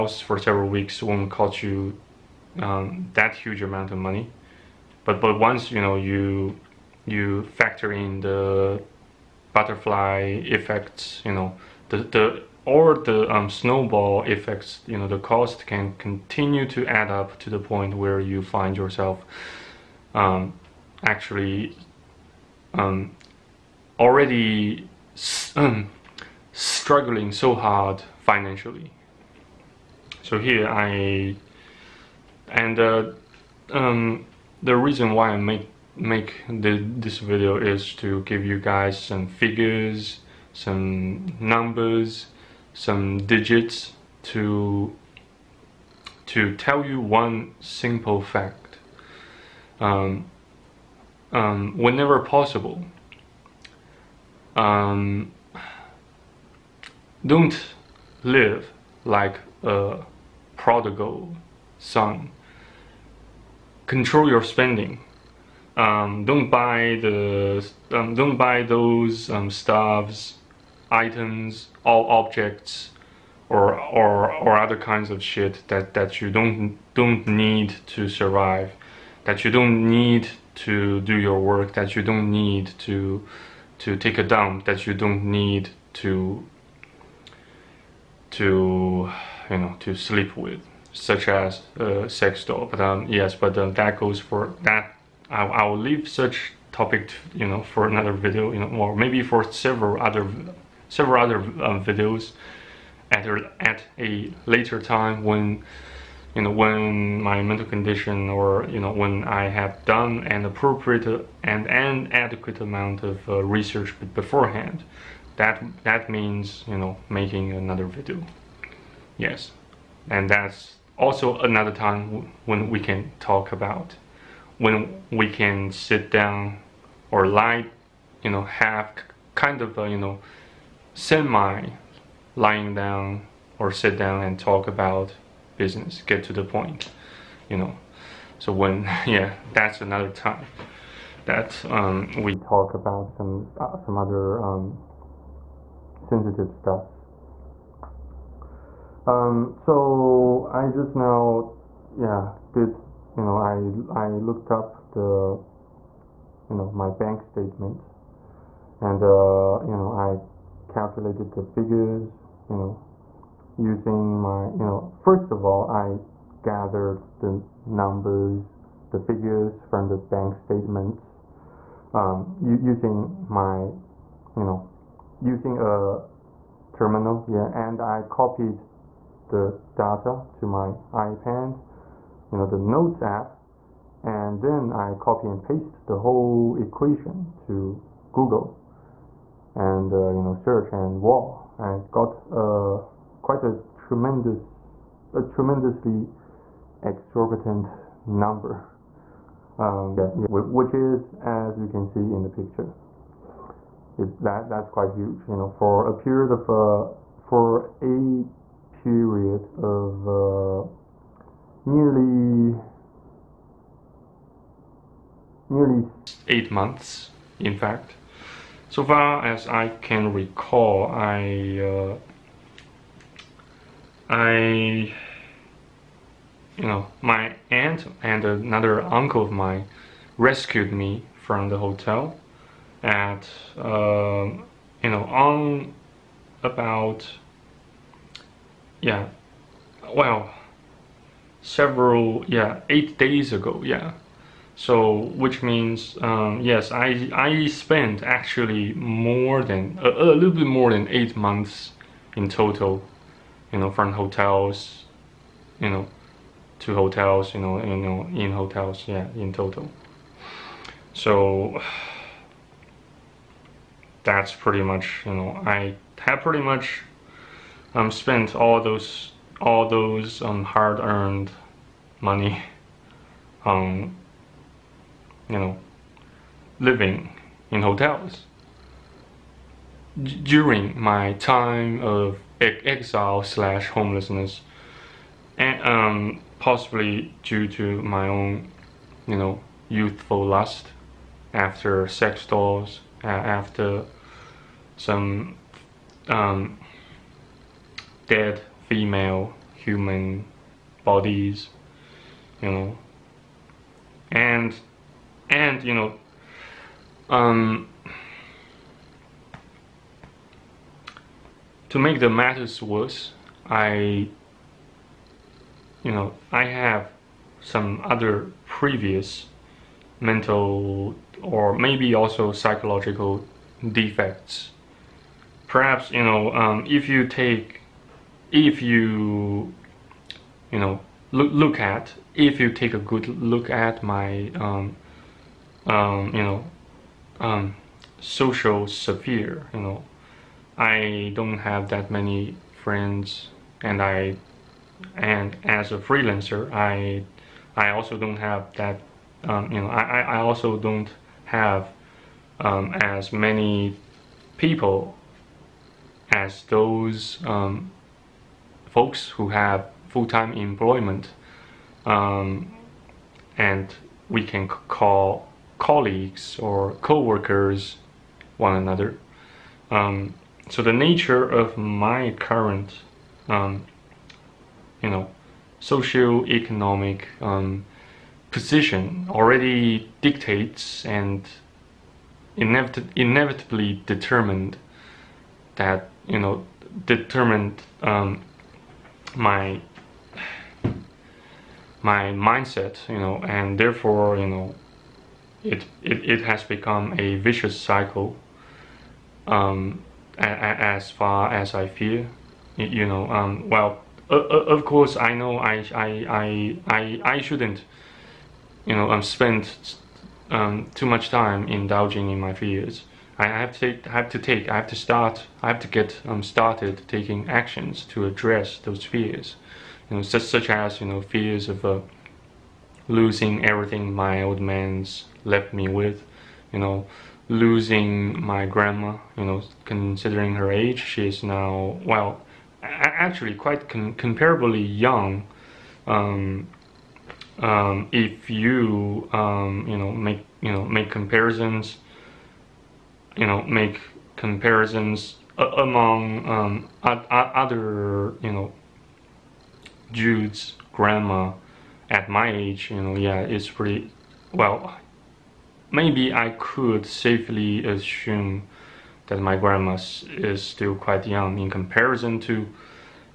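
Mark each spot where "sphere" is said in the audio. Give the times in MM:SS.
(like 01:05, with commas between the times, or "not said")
05:38.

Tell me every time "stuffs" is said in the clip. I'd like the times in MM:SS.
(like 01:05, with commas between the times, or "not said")
01:09, 02:26.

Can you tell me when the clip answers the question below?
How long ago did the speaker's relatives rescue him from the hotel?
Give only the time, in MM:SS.
04:02.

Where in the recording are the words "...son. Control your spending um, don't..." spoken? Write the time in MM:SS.
01:01.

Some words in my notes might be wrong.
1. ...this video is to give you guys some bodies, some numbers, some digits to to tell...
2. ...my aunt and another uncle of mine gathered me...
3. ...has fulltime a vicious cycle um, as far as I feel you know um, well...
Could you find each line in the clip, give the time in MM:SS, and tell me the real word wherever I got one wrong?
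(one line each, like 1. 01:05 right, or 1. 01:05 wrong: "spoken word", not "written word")
1. 00:36 wrong: "figures", not "bodies"
2. 03:47 wrong: "rescued", not "gathered"
3. 06:36 wrong: "become", not "fulltime".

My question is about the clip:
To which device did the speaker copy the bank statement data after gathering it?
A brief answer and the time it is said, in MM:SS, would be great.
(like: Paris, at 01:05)
iPad, at 03:00.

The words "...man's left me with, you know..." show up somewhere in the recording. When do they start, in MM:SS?
07:04.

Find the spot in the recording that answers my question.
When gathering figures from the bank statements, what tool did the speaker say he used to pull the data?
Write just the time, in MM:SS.
02:55.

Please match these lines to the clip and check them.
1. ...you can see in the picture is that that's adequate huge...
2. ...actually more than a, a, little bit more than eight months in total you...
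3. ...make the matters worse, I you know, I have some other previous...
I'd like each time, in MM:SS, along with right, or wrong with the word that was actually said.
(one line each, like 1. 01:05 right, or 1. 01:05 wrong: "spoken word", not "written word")
1. 03:21 wrong: "quite", not "adequate"
2. 04:08 right
3. 05:11 right.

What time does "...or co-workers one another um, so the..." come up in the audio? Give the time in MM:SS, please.
06:06.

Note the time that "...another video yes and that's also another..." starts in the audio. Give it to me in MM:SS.
01:57.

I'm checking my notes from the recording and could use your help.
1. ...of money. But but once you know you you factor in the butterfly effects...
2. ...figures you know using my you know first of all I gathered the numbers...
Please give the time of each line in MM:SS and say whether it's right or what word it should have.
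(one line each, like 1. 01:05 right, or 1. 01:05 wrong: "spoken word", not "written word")
1. 00:03 right
2. 02:41 right.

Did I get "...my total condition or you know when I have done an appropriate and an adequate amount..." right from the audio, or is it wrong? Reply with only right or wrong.
wrong.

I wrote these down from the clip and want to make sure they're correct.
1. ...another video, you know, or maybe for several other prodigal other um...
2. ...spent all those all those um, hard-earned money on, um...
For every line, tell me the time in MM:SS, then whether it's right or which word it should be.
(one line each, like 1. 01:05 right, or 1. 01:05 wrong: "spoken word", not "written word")
1. 01:37 wrong: "several", not "prodigal"
2. 04:27 right.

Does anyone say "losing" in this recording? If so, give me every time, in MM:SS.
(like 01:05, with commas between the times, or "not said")
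07:02, 07:07.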